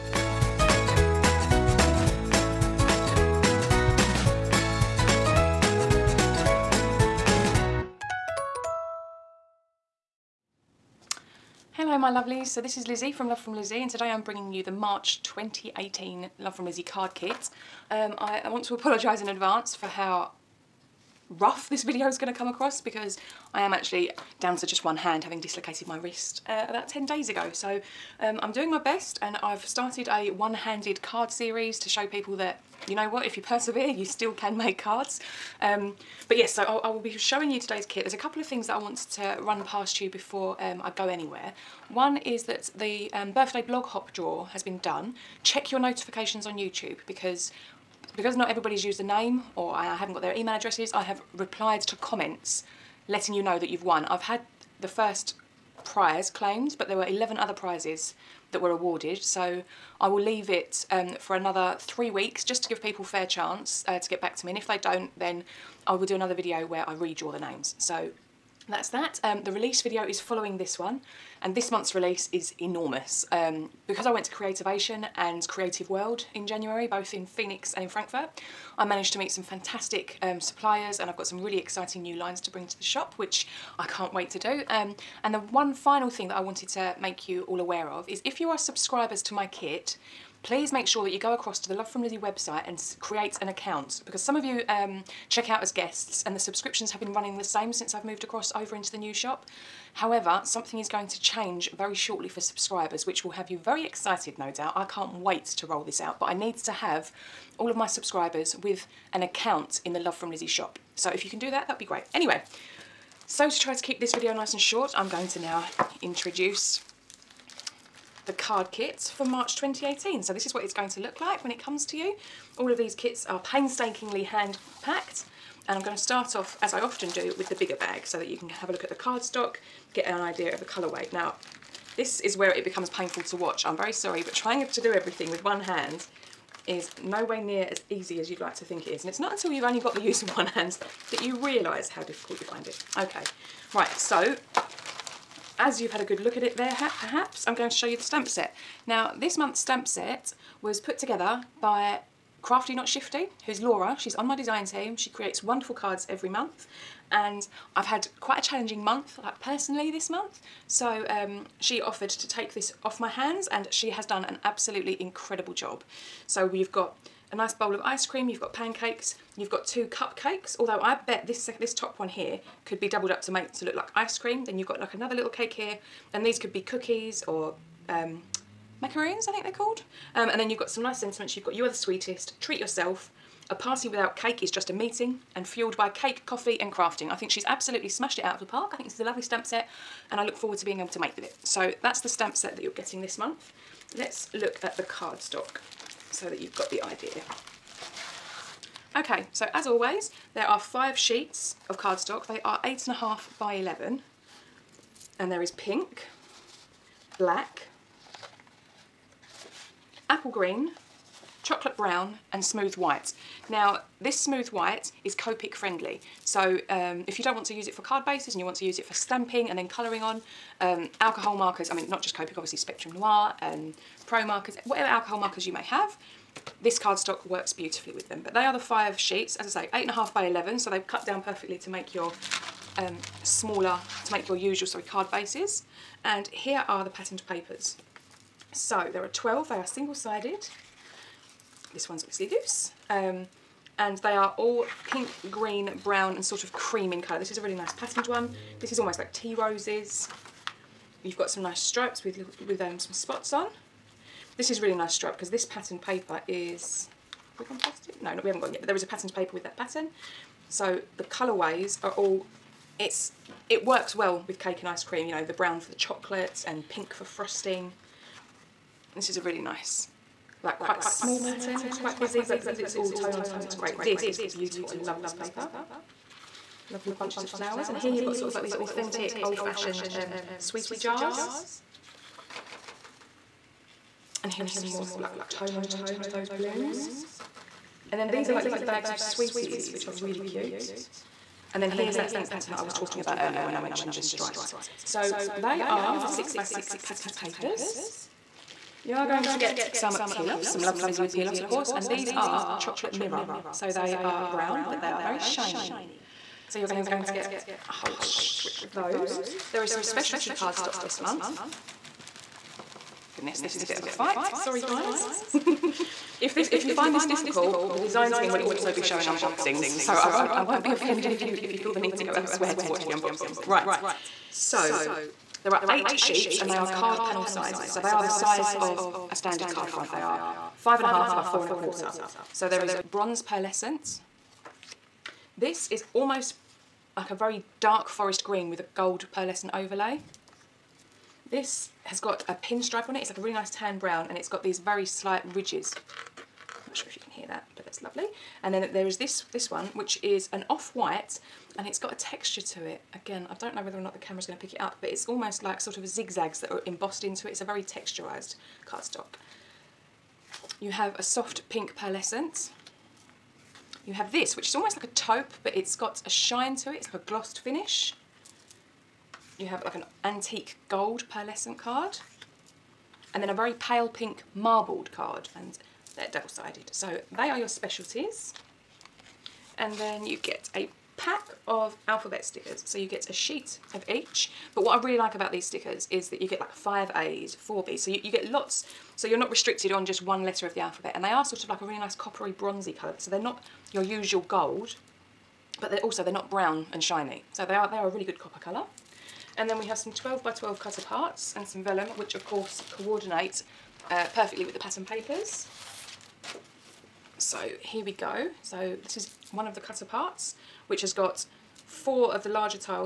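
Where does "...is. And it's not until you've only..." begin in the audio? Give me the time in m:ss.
2:18.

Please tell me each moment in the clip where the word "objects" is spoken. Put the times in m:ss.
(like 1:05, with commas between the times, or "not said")
not said.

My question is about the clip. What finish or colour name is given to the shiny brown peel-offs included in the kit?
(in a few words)
chocolate mirror.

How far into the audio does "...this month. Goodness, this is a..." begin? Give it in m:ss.
5:10.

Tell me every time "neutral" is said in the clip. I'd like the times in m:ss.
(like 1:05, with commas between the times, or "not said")
not said.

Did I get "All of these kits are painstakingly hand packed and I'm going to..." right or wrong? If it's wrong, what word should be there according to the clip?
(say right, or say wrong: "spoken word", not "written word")
right.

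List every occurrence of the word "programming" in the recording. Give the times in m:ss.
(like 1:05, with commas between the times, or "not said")
not said.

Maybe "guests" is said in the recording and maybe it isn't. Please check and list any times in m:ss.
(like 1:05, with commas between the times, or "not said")
1:35.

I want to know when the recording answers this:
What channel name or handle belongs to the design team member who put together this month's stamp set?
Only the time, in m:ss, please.
2:32.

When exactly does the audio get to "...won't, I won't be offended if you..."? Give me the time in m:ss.
5:20.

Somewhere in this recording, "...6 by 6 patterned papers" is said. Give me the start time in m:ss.
4:56.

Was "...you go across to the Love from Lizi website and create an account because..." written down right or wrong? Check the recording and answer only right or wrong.
right.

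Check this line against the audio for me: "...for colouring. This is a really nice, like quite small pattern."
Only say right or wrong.
wrong.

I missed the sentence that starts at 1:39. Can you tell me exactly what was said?
However, something is going to change very shortly for subscribers, which will have you very excited, no doubt.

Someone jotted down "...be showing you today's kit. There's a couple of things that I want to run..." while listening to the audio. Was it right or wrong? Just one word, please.
right.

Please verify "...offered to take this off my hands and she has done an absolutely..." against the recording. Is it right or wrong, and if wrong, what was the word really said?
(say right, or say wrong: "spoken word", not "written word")
right.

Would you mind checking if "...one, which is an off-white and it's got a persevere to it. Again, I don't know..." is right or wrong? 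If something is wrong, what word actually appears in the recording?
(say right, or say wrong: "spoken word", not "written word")
wrong: "texture", not "persevere".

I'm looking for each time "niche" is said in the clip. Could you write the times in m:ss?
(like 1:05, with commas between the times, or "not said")
not said.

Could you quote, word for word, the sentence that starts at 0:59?
So I will leave it um, for another three weeks just to give people fair chance uh, to get back to me.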